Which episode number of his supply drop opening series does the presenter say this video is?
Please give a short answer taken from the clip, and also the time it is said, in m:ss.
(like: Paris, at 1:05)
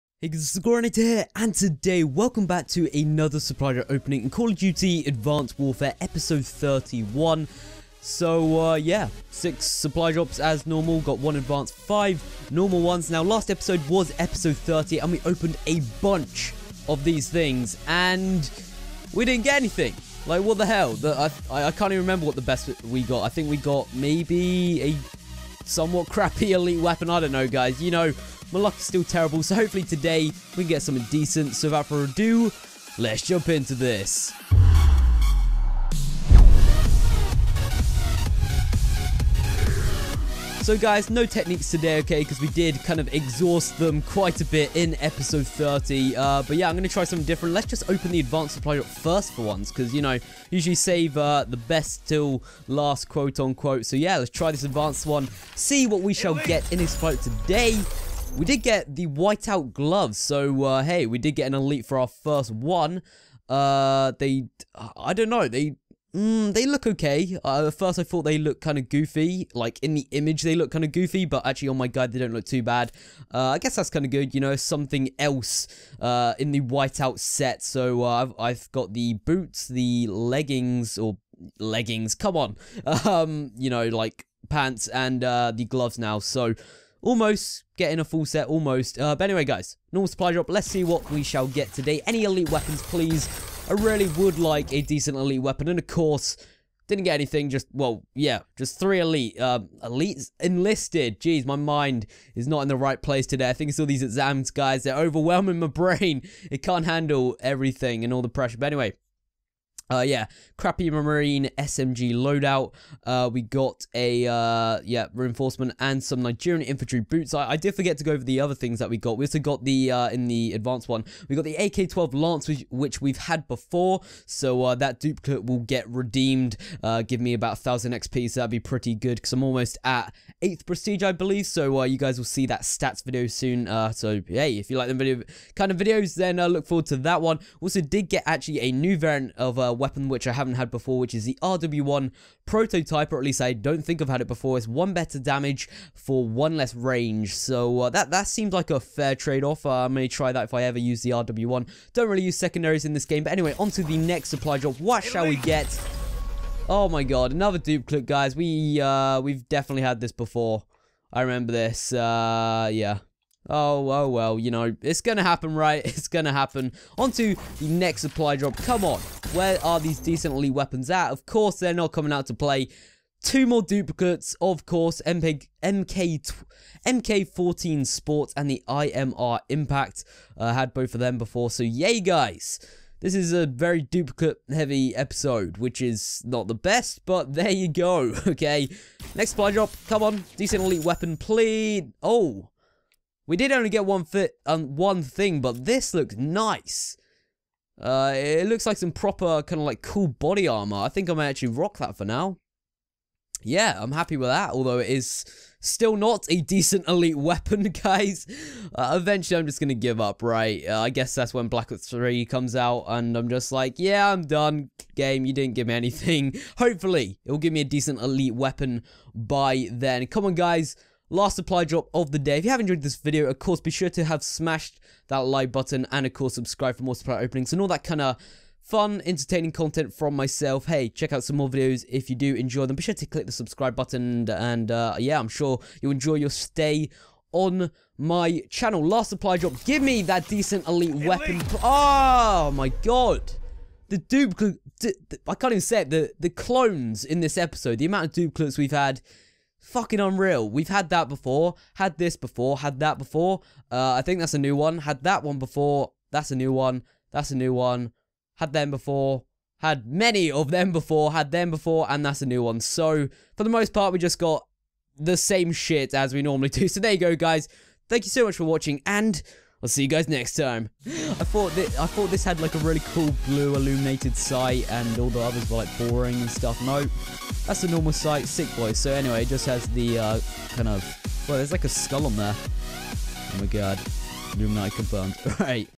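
31, at 0:05.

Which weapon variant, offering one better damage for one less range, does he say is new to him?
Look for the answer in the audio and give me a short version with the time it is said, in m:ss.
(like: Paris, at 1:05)
RW1 prototype, at 2:21.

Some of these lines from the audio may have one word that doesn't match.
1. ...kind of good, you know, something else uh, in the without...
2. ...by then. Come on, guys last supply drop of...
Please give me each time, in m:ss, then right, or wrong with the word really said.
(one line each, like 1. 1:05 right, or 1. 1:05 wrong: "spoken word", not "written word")
1. 1:13 wrong: "whiteout", not "without"
2. 3:39 right.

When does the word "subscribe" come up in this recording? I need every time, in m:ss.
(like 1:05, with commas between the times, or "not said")
3:46, 3:53.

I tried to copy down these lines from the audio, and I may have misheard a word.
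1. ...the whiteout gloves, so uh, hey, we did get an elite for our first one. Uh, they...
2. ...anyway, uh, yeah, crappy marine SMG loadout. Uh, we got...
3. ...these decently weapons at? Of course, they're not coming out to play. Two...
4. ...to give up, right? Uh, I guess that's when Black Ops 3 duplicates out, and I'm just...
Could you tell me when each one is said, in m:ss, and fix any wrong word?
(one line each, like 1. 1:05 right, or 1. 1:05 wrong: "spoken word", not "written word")
1. 0:58 right
2. 1:48 right
3. 2:49 right
4. 3:29 wrong: "comes", not "duplicates".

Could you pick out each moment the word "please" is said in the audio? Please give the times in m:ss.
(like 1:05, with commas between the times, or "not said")
1:32, 3:11.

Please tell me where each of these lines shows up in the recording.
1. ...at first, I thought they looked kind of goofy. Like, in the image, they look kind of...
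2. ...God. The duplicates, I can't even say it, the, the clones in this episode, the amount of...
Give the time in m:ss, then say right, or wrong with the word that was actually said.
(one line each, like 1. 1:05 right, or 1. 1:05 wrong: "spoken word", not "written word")
1. 1:07 right
2. 4:02 right.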